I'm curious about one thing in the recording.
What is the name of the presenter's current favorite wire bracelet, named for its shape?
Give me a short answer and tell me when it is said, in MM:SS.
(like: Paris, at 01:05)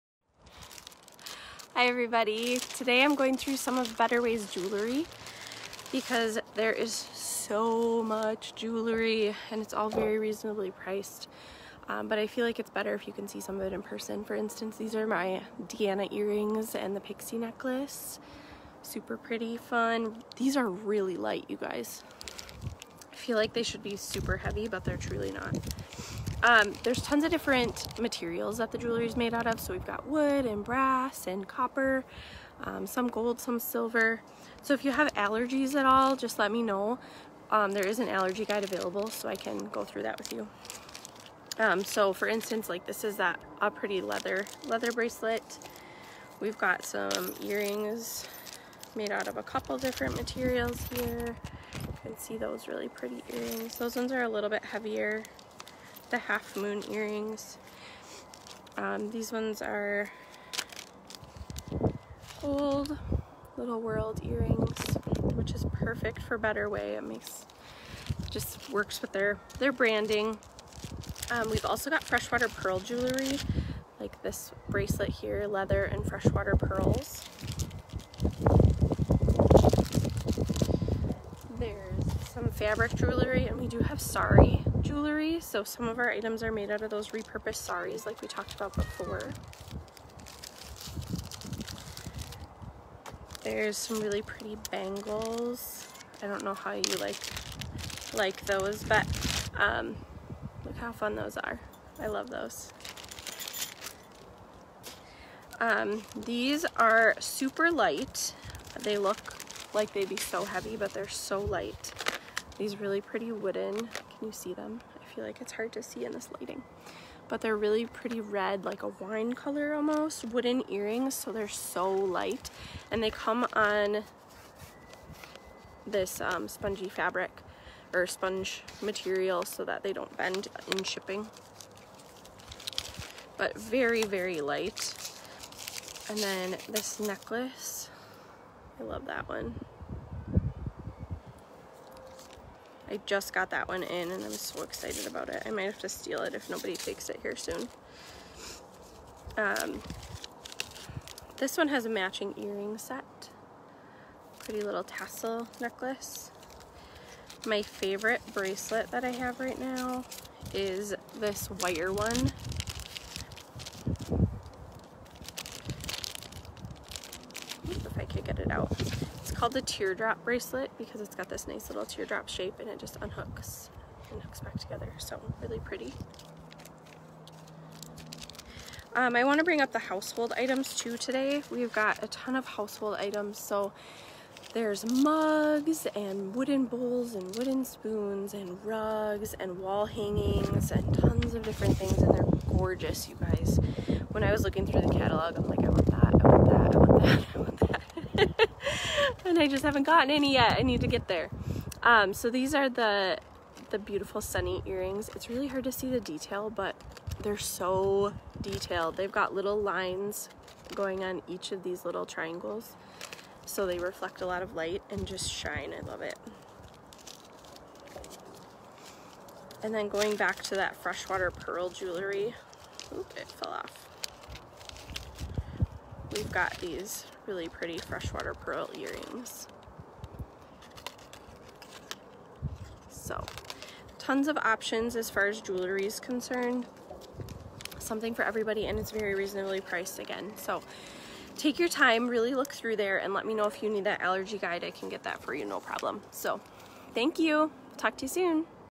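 teardrop bracelet, at 02:49.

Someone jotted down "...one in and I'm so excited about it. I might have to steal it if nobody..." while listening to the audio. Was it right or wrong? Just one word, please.
right.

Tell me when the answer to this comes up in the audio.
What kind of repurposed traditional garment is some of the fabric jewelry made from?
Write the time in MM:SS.
01:27.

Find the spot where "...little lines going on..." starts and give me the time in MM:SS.
03:29.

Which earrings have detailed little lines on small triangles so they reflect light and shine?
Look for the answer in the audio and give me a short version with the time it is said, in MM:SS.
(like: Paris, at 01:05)
sunny earrings, at 03:24.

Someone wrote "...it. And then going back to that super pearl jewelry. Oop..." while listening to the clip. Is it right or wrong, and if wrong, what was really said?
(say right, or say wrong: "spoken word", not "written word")
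wrong: "freshwater", not "super".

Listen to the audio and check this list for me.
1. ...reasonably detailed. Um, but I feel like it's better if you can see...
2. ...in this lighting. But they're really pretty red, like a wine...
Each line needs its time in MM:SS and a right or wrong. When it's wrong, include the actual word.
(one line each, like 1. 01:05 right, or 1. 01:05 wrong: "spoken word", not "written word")
1. 00:10 wrong: "priced", not "detailed"
2. 01:56 right.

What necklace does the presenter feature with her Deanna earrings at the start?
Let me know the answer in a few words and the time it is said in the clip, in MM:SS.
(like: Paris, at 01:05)
pixie necklace, at 00:16.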